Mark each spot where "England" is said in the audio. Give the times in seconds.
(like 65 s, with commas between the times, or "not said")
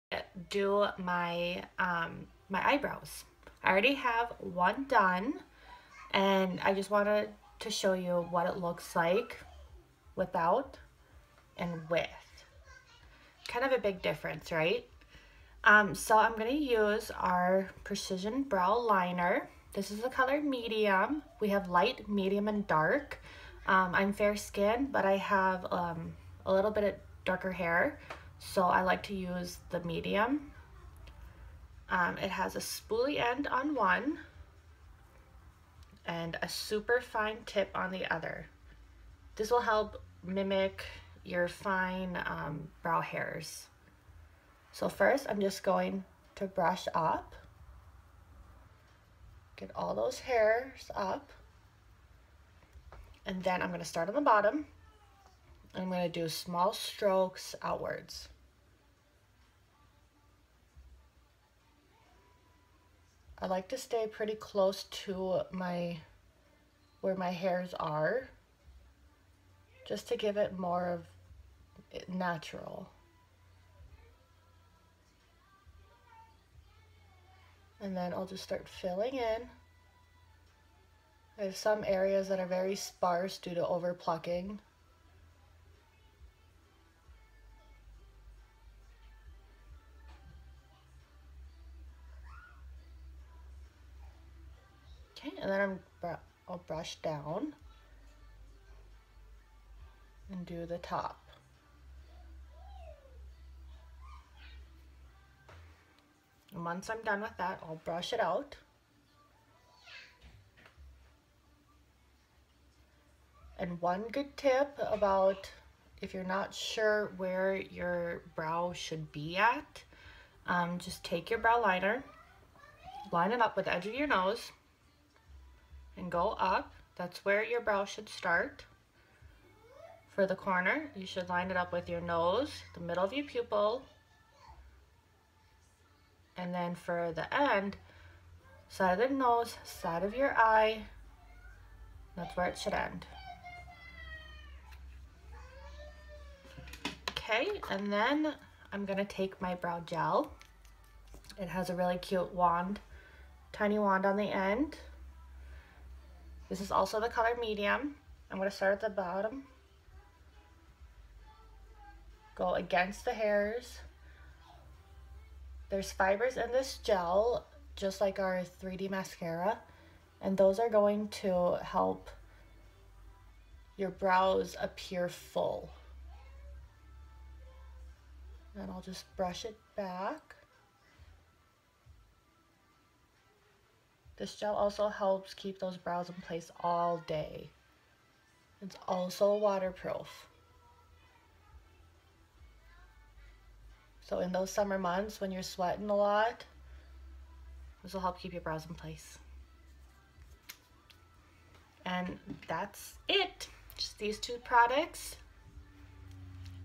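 not said.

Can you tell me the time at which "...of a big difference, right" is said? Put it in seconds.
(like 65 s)
13 s.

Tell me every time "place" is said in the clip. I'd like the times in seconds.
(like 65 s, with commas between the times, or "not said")
186 s, 198 s.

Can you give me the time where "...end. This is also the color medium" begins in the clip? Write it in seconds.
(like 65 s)
154 s.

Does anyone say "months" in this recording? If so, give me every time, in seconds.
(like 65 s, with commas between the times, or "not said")
194 s.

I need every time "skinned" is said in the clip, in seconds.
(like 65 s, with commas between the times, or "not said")
24 s.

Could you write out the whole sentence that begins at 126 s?
That's where your brow should start.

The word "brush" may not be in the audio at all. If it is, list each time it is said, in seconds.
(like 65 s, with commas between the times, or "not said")
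46 s, 96 s, 107 s, 179 s.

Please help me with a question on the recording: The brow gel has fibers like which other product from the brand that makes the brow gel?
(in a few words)
3D mascara.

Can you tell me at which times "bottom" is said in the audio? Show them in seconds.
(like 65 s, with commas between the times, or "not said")
54 s, 158 s.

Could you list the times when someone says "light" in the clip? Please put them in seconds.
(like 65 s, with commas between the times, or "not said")
21 s.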